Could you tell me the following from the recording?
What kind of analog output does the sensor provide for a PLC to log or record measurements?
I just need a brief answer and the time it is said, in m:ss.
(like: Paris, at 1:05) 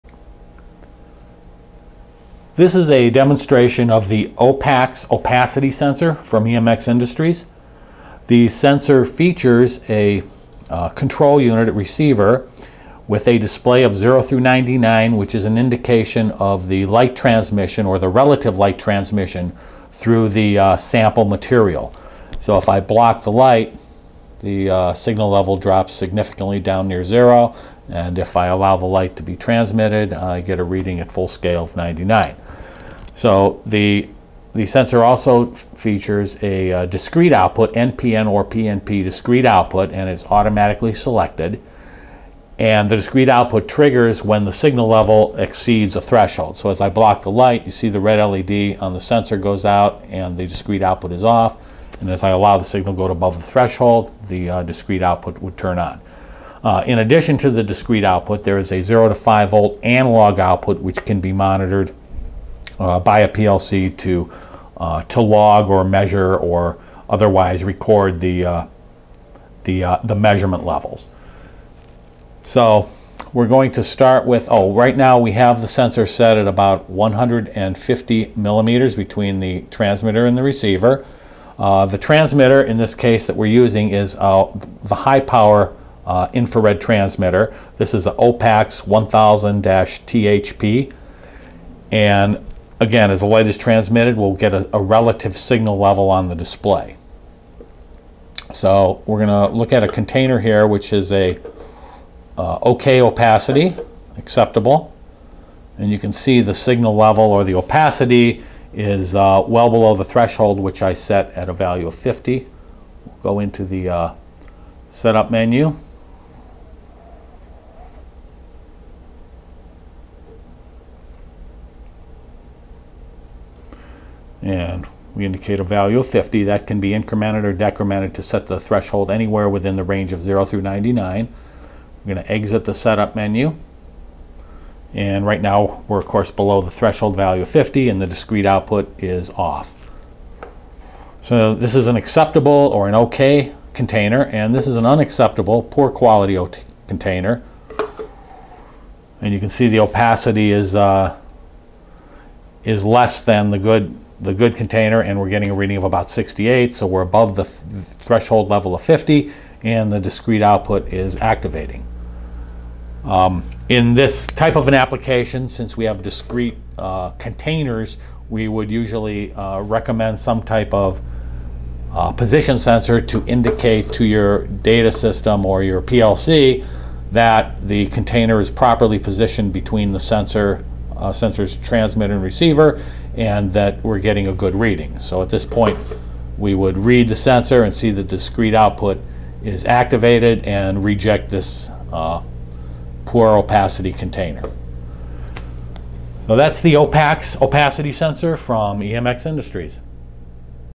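0 to 5 volt, at 0:58.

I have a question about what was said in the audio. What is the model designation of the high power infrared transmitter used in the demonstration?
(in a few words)
OPAX 1000-THP.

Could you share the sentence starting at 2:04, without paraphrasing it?
And we indicate a value of 50.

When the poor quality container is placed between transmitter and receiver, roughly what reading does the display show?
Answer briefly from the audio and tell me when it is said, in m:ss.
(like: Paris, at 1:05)
68, at 2:36.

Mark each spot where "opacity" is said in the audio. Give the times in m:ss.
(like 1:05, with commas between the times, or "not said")
0:05, 1:43, 1:47, 2:29, 3:13, 3:17.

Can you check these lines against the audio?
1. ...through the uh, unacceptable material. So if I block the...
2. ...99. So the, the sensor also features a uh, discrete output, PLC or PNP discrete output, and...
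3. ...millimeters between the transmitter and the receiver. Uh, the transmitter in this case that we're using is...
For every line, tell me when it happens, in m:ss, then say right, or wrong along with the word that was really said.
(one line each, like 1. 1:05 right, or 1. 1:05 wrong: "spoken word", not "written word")
1. 0:19 wrong: "sample", not "unacceptable"
2. 0:31 wrong: "NPN", not "PLC"
3. 1:18 right.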